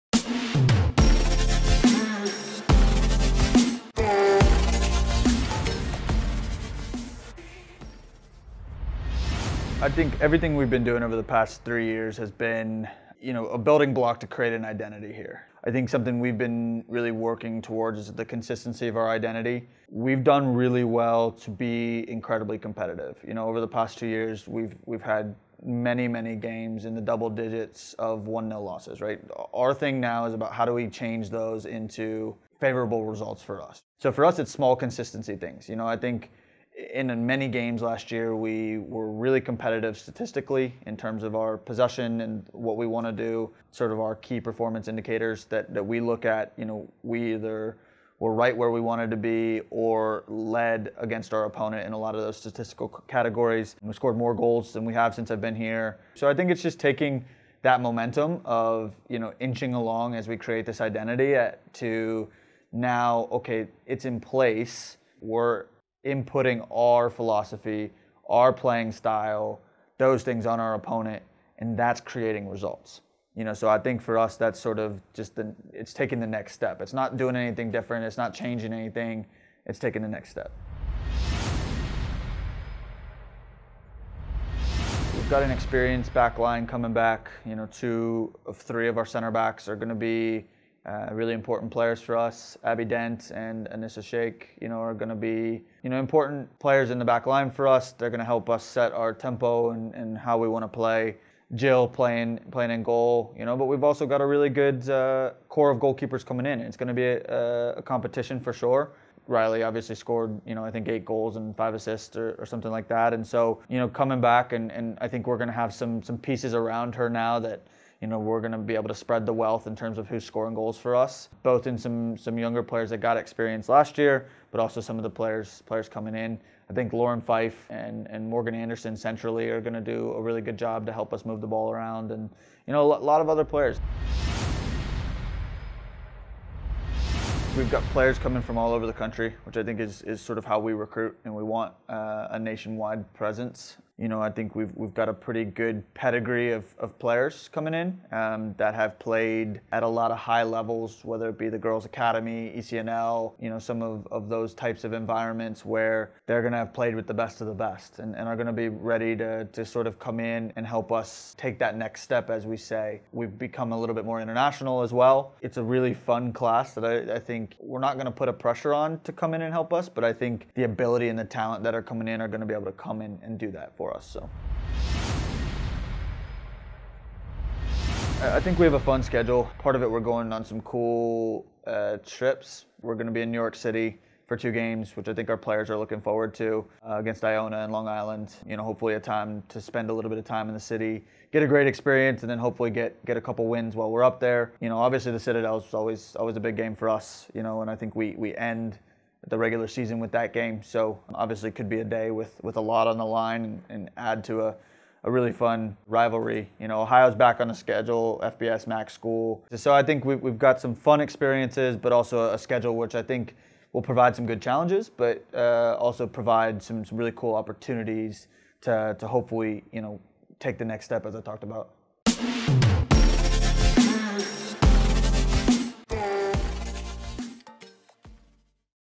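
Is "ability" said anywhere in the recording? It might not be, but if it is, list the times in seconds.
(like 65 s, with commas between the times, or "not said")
170 s.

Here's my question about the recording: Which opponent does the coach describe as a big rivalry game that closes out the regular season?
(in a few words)
The Citadel.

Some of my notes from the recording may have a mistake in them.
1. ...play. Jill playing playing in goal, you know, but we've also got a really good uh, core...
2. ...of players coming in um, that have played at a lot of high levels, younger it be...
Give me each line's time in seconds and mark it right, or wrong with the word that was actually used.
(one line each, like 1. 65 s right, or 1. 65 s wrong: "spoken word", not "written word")
1. 100 s right
2. 146 s wrong: "whether", not "younger".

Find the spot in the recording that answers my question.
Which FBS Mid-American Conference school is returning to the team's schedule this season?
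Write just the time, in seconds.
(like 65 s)
206 s.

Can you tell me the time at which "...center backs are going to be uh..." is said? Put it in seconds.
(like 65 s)
89 s.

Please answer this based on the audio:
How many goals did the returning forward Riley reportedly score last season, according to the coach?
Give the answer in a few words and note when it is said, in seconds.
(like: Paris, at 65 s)
8, at 110 s.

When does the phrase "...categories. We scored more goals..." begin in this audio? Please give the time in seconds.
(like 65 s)
53 s.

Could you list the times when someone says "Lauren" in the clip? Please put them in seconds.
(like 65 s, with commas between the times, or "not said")
126 s.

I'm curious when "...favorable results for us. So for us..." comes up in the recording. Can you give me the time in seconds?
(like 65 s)
32 s.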